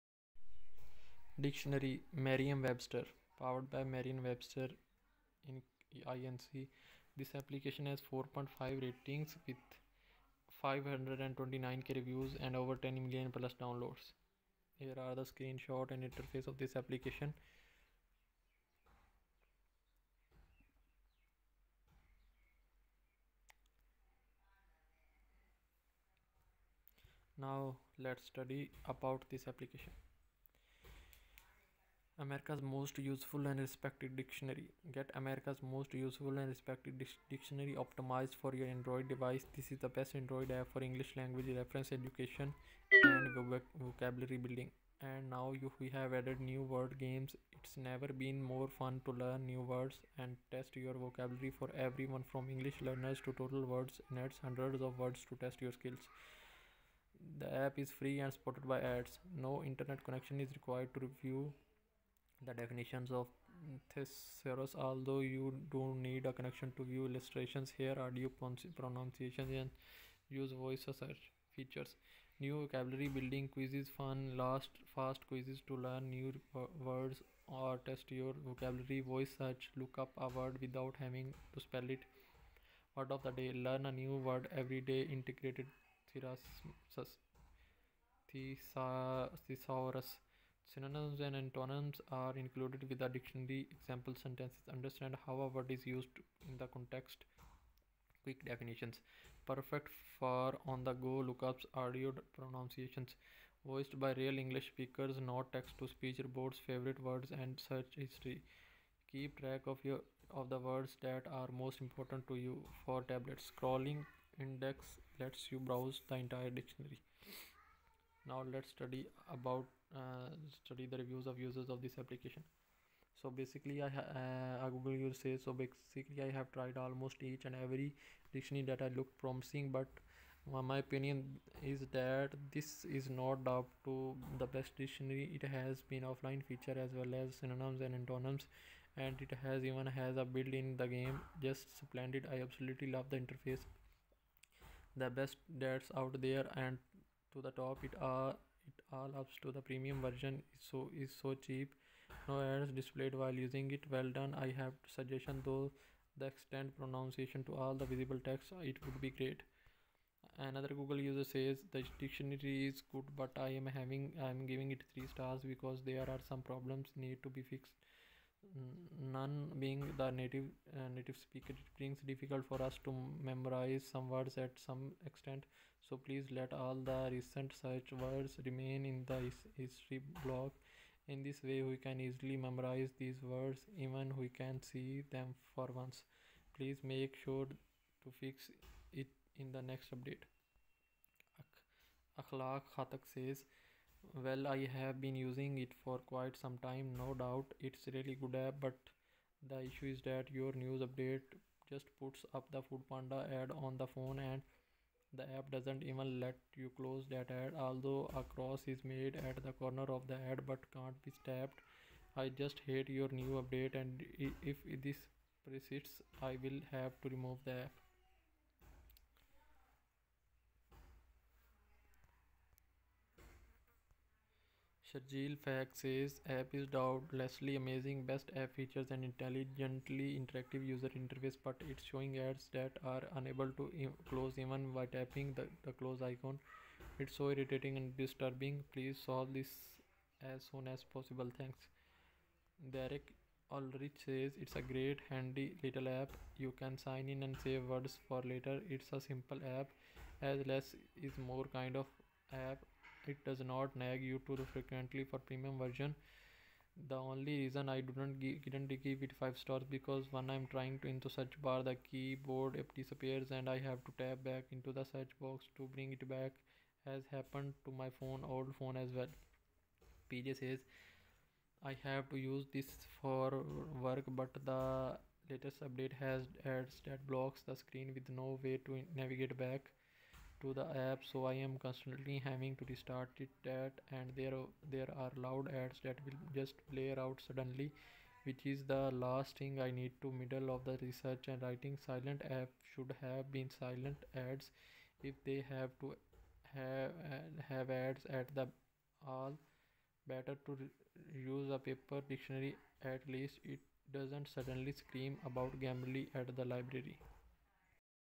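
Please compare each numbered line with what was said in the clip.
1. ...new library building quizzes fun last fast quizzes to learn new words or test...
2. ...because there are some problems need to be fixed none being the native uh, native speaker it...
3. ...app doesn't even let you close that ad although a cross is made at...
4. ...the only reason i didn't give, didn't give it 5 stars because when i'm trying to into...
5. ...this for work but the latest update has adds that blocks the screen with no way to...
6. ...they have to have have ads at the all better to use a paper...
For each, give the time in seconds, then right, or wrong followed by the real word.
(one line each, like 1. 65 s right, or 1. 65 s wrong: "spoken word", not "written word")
1. 72 s wrong: "vocabulary", not "library"
2. 165 s right
3. 205 s right
4. 256 s right
5. 272 s right
6. 295 s right.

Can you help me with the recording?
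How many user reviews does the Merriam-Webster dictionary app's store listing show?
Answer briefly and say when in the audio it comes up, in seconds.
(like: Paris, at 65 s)
529k, at 10 s.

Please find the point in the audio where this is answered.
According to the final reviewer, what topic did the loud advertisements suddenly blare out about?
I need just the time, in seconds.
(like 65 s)
305 s.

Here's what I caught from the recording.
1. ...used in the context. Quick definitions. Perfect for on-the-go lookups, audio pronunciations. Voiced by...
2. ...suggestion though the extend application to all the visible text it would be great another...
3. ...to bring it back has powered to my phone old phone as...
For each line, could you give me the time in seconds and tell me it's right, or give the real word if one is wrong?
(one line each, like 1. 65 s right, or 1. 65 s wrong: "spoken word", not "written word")
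1. 95 s right
2. 154 s wrong: "pronunciation", not "application"
3. 265 s wrong: "happened", not "powered".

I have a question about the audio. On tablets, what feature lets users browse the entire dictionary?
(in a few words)
Scrolling index.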